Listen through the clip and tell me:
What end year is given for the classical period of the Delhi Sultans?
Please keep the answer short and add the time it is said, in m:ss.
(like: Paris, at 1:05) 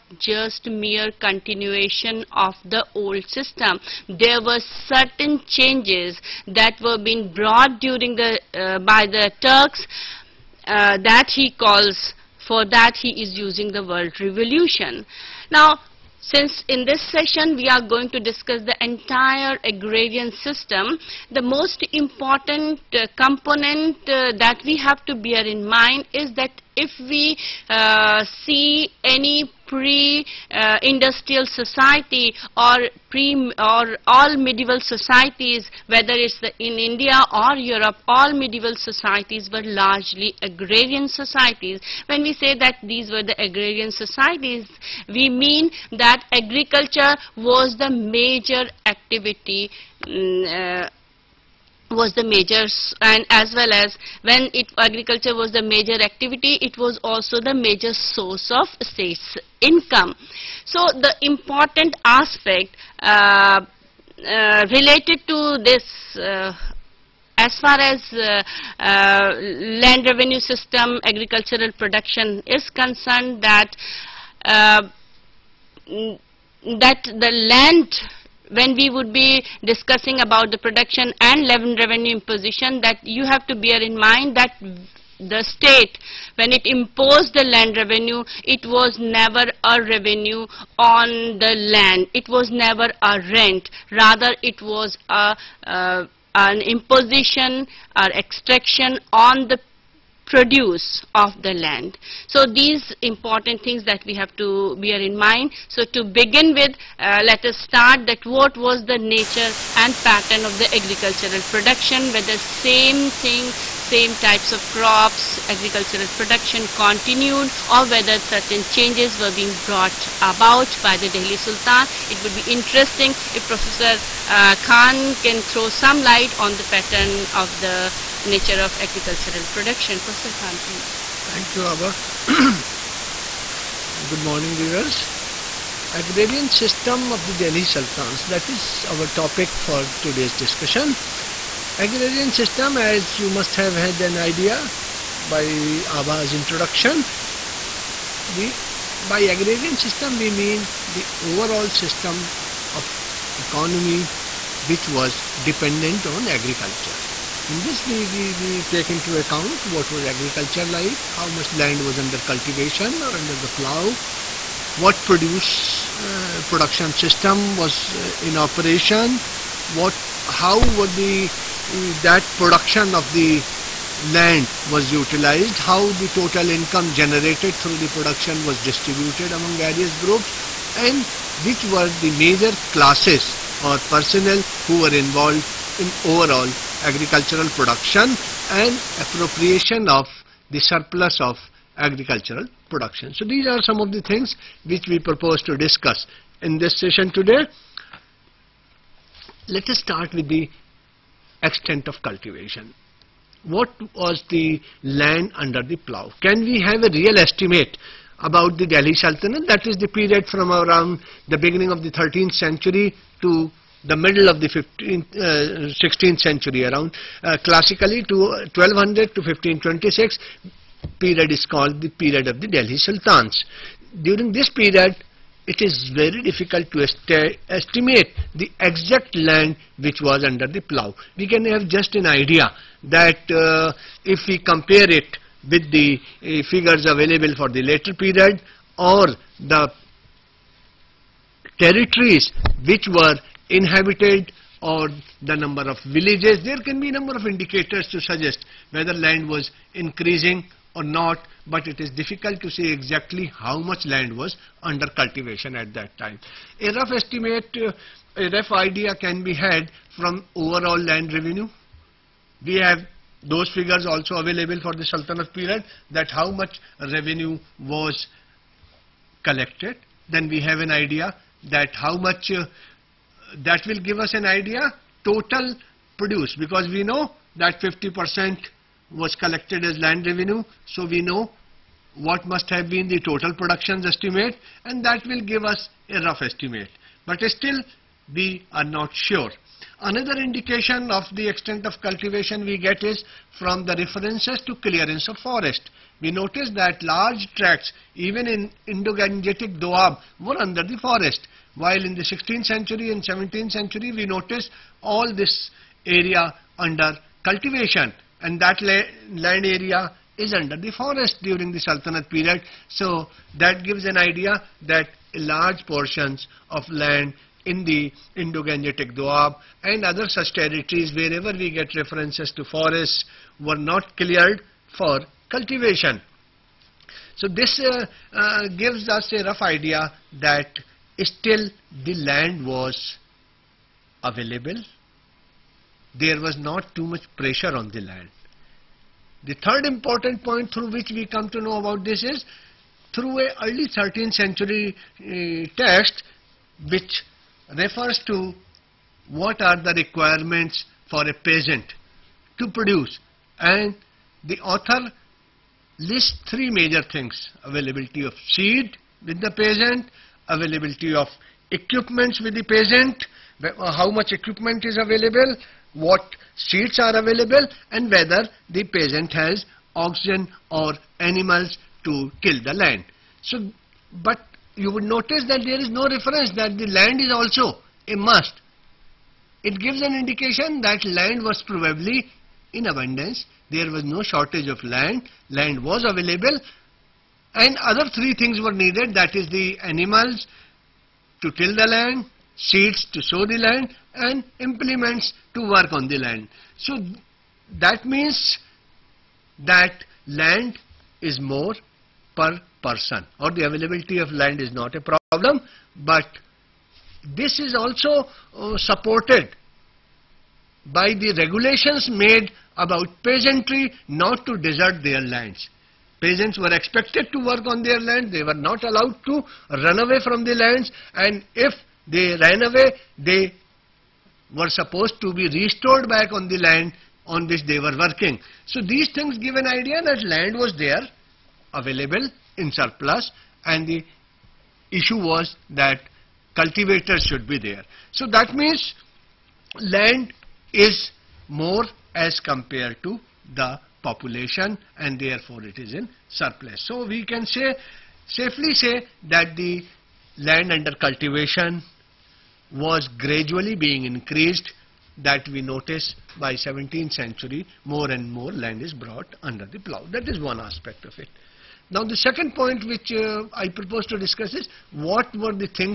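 1526, at 3:39.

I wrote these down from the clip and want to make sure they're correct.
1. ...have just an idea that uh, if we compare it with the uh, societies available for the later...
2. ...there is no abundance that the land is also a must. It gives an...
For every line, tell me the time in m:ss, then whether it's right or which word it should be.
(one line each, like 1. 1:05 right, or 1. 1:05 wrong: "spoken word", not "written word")
1. 3:51 wrong: "figures", not "societies"
2. 6:15 wrong: "reference", not "abundance".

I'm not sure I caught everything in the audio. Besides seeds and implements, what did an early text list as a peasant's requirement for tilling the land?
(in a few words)
oxen.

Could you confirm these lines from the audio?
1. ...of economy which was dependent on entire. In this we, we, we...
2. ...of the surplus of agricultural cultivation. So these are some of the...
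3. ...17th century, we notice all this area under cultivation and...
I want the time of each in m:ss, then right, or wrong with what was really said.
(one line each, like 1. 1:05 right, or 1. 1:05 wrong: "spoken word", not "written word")
1. 2:32 wrong: "agriculture", not "entire"
2. 3:09 wrong: "production", not "cultivation"
3. 5:03 right.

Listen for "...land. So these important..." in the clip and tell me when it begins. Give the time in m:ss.
1:41.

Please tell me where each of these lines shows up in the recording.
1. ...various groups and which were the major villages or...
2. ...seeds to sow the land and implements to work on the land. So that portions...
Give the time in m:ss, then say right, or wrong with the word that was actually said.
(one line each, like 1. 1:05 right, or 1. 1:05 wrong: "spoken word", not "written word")
1. 2:59 wrong: "classes", not "villages"
2. 6:32 wrong: "means", not "portions".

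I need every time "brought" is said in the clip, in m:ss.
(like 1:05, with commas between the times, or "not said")
0:07, 1:59, 7:38.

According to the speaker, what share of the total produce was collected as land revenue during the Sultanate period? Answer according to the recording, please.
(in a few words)
50%.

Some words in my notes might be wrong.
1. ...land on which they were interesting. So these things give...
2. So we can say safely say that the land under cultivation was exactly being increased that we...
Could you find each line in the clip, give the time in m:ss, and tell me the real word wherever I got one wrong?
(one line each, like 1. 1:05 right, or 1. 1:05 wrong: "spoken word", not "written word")
1. 7:06 wrong: "working", not "interesting"
2. 7:26 wrong: "gradually", not "exactly".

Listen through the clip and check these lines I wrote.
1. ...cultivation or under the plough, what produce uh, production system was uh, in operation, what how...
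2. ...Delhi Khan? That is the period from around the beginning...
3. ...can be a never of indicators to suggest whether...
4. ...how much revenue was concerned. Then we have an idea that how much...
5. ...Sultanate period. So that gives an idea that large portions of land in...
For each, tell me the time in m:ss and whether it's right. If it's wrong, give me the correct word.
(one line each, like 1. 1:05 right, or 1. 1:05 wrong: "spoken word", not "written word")
1. 2:42 right
2. 3:28 wrong: "Sultanate", not "Khan"
3. 4:06 wrong: "number", not "never"
4. 4:26 wrong: "collected", not "concerned"
5. 5:11 right.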